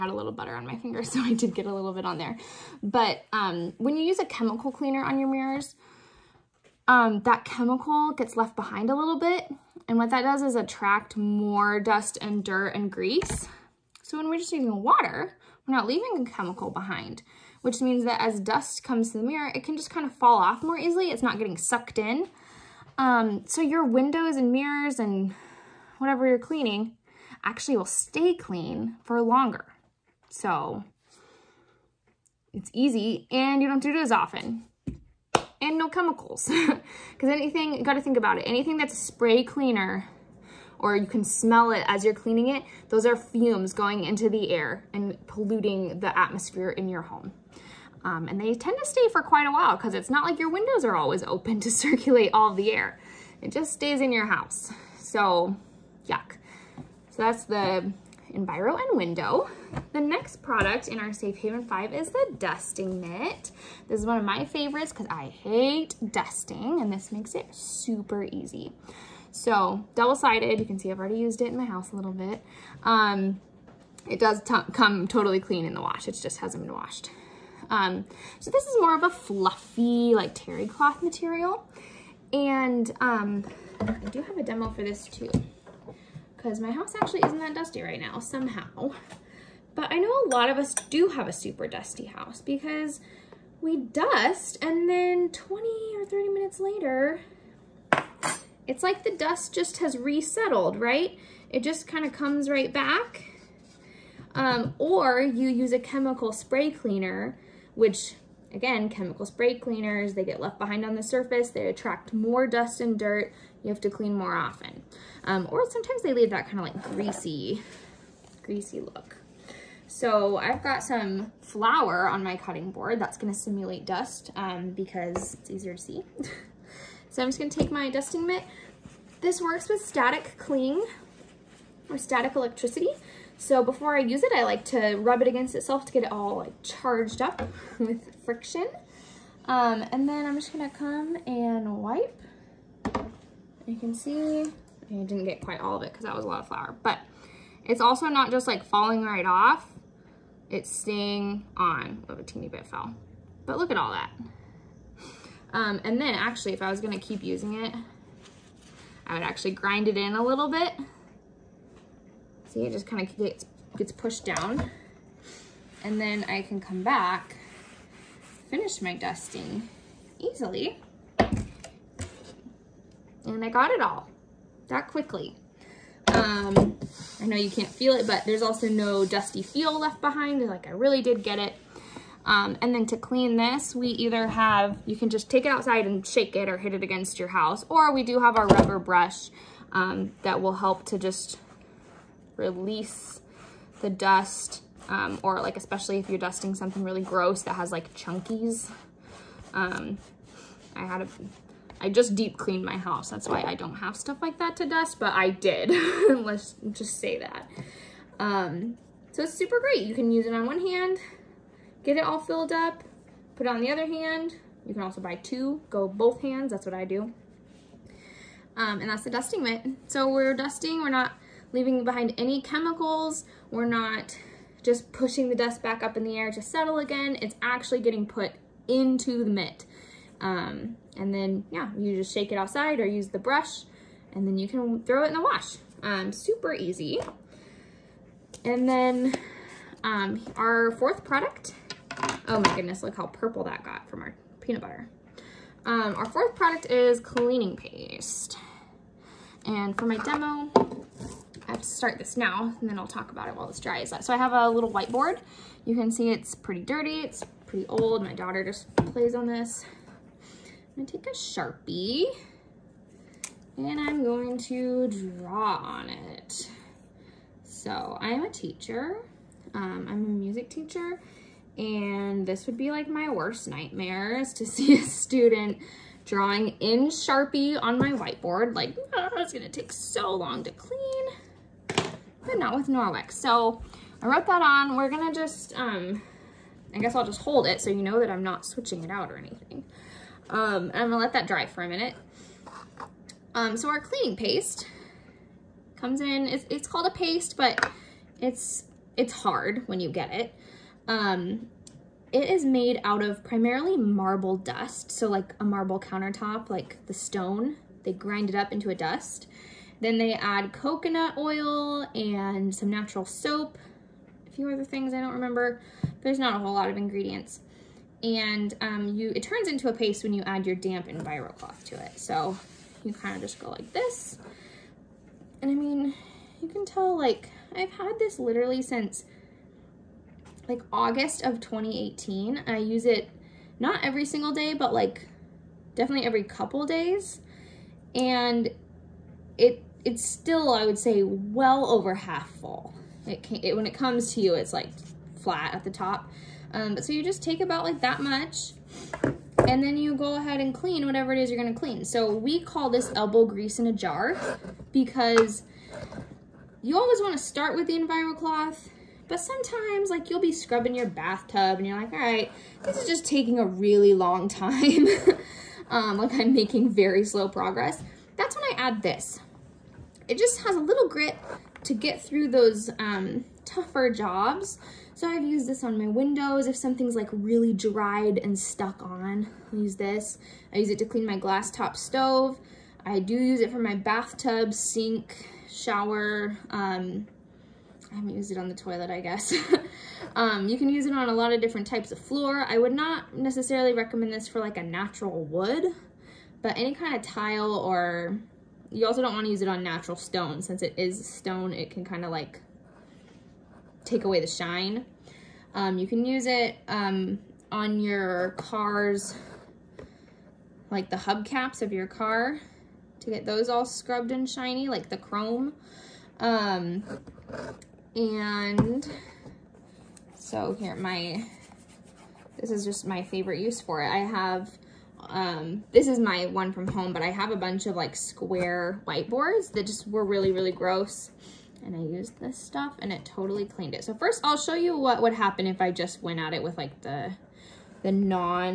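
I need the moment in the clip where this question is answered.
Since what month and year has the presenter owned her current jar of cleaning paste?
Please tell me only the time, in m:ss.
5:30.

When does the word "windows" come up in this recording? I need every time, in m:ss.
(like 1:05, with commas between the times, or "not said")
0:23, 0:50, 0:58, 6:15.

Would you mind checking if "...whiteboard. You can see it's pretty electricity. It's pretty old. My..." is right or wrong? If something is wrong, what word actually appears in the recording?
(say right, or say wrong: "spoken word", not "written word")
wrong: "dirty", not "electricity".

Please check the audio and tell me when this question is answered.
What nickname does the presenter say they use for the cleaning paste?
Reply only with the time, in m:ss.
5:52.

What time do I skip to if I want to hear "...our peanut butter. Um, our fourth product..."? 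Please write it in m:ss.
4:04.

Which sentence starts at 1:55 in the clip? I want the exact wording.
Um, or sometimes they leave that kind of like greasy, greasy look.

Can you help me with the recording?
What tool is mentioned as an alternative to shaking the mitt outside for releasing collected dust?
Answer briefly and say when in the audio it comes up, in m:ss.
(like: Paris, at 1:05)
Rubber brush, at 3:08.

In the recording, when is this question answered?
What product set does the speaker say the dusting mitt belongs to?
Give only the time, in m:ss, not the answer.
1:01.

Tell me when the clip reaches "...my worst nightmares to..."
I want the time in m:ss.
4:32.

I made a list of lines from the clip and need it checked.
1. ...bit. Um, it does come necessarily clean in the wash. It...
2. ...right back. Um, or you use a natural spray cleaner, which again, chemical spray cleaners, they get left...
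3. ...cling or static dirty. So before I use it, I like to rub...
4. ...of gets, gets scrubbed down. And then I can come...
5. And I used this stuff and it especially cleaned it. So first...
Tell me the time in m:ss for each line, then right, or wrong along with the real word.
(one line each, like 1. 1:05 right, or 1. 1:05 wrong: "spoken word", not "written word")
1. 1:12 wrong: "totally", not "necessarily"
2. 1:42 wrong: "chemical", not "natural"
3. 2:10 wrong: "electricity", not "dirty"
4. 2:43 wrong: "pushed", not "scrubbed"
5. 7:11 wrong: "totally", not "especially".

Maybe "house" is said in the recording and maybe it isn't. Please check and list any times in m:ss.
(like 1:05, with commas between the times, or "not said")
0:54, 1:11, 1:26, 1:32, 3:07, 3:22.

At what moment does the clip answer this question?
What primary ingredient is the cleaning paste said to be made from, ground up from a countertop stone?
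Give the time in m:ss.
5:03.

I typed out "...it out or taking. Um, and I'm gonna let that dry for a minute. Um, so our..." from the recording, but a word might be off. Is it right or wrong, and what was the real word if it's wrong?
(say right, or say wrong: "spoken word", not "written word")
wrong: "anything", not "taking".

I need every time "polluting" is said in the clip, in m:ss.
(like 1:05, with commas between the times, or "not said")
0:45.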